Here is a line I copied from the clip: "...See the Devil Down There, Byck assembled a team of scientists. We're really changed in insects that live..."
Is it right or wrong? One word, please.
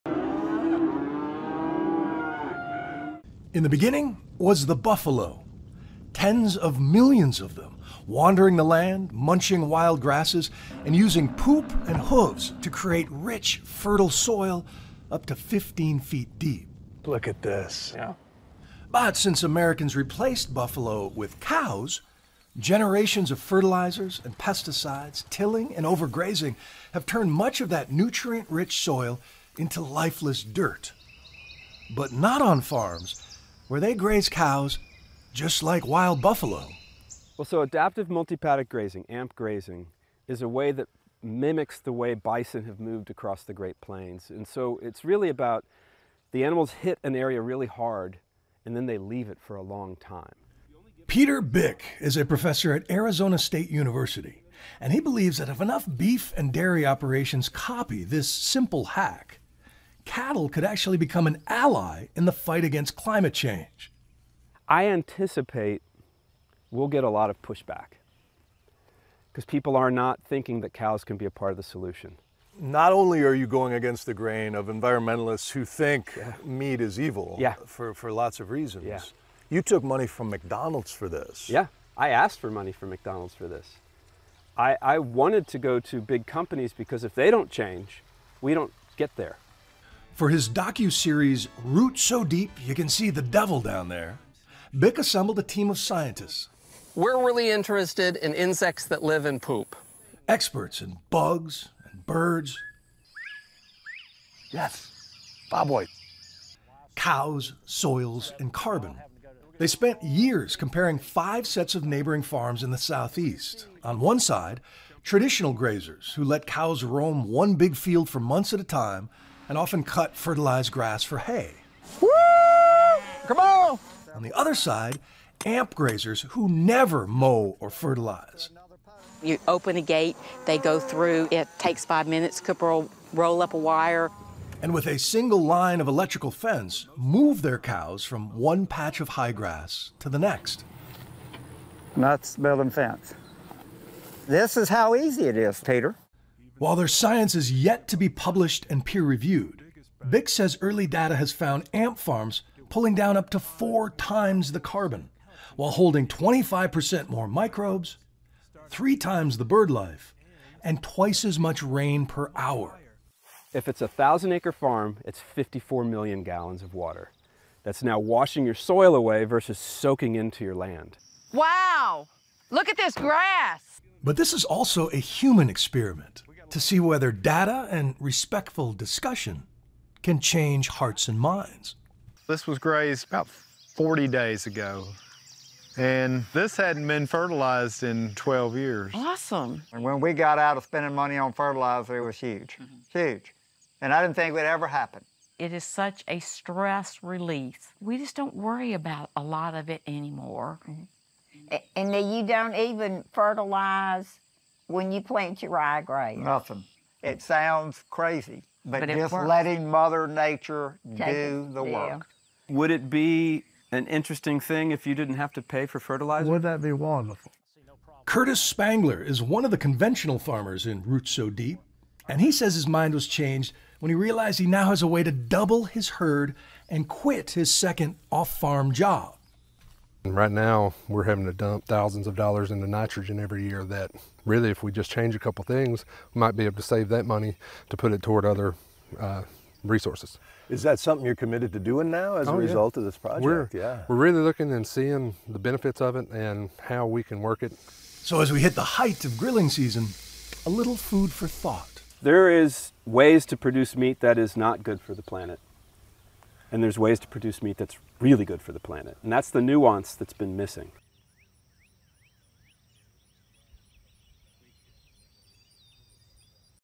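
wrong.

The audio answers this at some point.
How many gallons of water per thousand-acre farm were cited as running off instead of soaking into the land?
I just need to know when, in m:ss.
2:45.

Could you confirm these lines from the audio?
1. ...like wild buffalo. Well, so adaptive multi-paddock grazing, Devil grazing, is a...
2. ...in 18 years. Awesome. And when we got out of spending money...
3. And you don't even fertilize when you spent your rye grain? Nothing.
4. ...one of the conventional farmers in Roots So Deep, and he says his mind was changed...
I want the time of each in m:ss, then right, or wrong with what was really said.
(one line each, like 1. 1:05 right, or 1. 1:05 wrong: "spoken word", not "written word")
1. 0:35 wrong: "AMP", not "Devil"
2. 3:07 wrong: "12", not "18"
3. 3:21 wrong: "plant", not "spent"
4. 3:39 right.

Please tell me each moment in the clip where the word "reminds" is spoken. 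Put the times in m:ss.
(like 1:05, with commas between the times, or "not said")
not said.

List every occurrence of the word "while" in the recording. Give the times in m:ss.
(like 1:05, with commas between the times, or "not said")
2:26, 2:35.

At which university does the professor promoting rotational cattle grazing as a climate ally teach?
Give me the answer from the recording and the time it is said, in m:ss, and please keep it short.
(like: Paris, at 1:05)
Arizona State University, at 0:52.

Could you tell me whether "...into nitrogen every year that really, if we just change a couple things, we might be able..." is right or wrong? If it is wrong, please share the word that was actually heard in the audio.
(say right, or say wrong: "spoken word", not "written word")
right.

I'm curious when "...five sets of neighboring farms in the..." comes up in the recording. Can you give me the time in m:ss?
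1:50.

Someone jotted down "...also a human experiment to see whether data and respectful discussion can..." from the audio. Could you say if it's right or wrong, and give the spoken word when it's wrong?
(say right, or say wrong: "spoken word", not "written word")
right.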